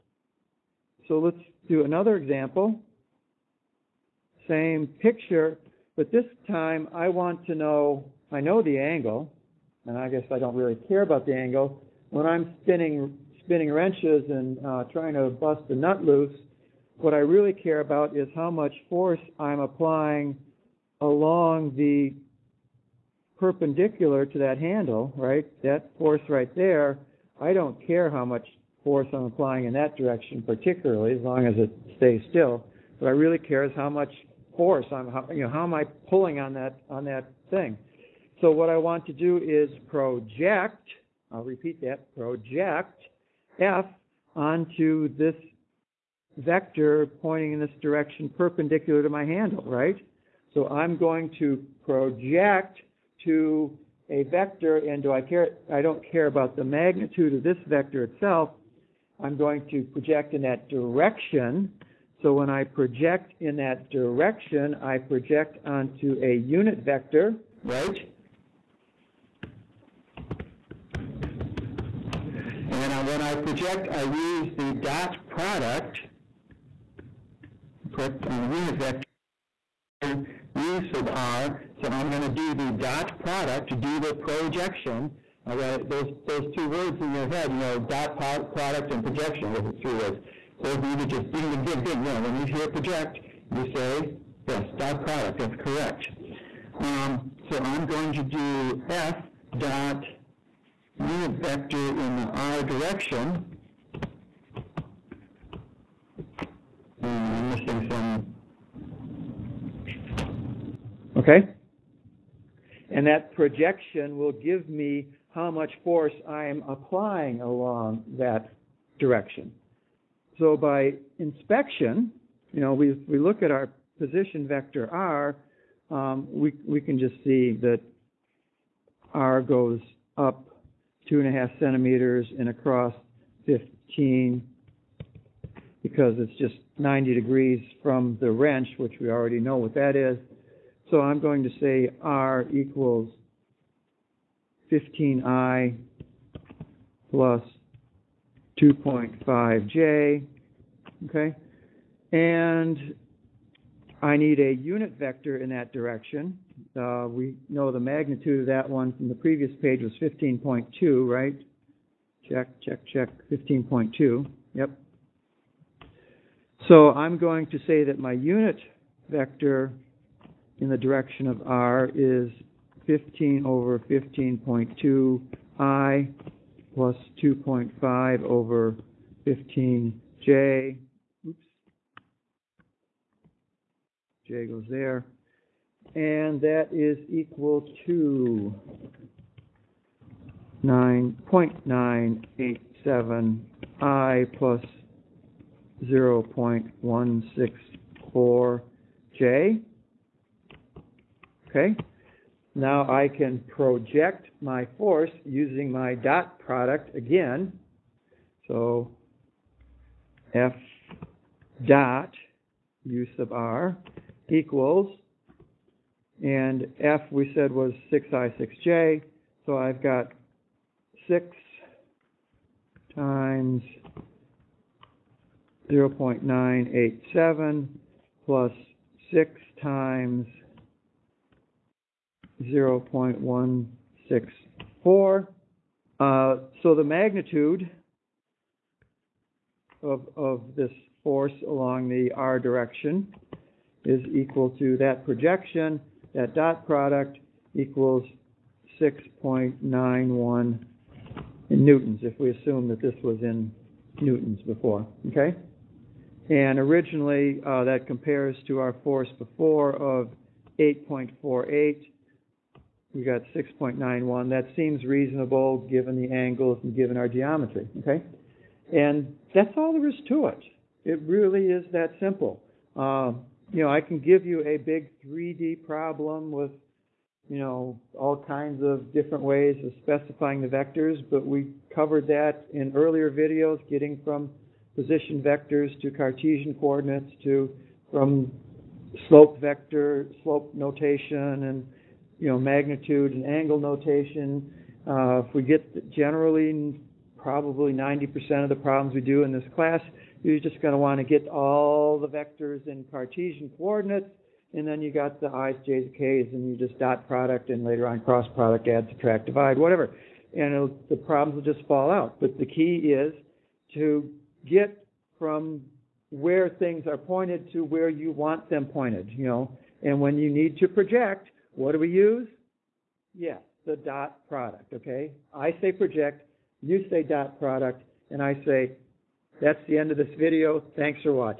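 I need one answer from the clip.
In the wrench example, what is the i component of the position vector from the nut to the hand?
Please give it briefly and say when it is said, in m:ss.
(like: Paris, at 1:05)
15, at 2:22.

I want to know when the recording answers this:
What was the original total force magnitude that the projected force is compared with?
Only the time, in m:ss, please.
4:20.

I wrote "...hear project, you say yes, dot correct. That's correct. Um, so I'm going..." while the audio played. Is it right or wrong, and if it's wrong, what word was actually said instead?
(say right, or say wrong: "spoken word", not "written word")
wrong: "product", not "correct".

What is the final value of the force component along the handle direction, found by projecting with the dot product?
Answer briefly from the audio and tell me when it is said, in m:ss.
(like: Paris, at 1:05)
6.91 newtons, at 4:08.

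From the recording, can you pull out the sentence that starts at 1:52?
And that projection will give me how much force I'm applying along that direction.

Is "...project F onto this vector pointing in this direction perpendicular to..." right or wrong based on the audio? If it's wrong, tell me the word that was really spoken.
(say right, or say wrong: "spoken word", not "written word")
right.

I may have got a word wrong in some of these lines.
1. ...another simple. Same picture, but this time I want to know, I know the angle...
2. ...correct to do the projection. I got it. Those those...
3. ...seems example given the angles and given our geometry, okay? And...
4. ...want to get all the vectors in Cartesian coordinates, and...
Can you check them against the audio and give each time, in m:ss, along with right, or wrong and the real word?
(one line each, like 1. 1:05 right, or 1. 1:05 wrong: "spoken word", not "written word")
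1. 0:01 wrong: "example", not "simple"
2. 1:23 wrong: "product", not "correct"
3. 4:24 wrong: "reasonable", not "example"
4. 5:00 right.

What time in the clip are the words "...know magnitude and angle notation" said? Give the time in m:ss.
4:52.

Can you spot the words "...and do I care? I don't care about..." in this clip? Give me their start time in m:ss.
0:54.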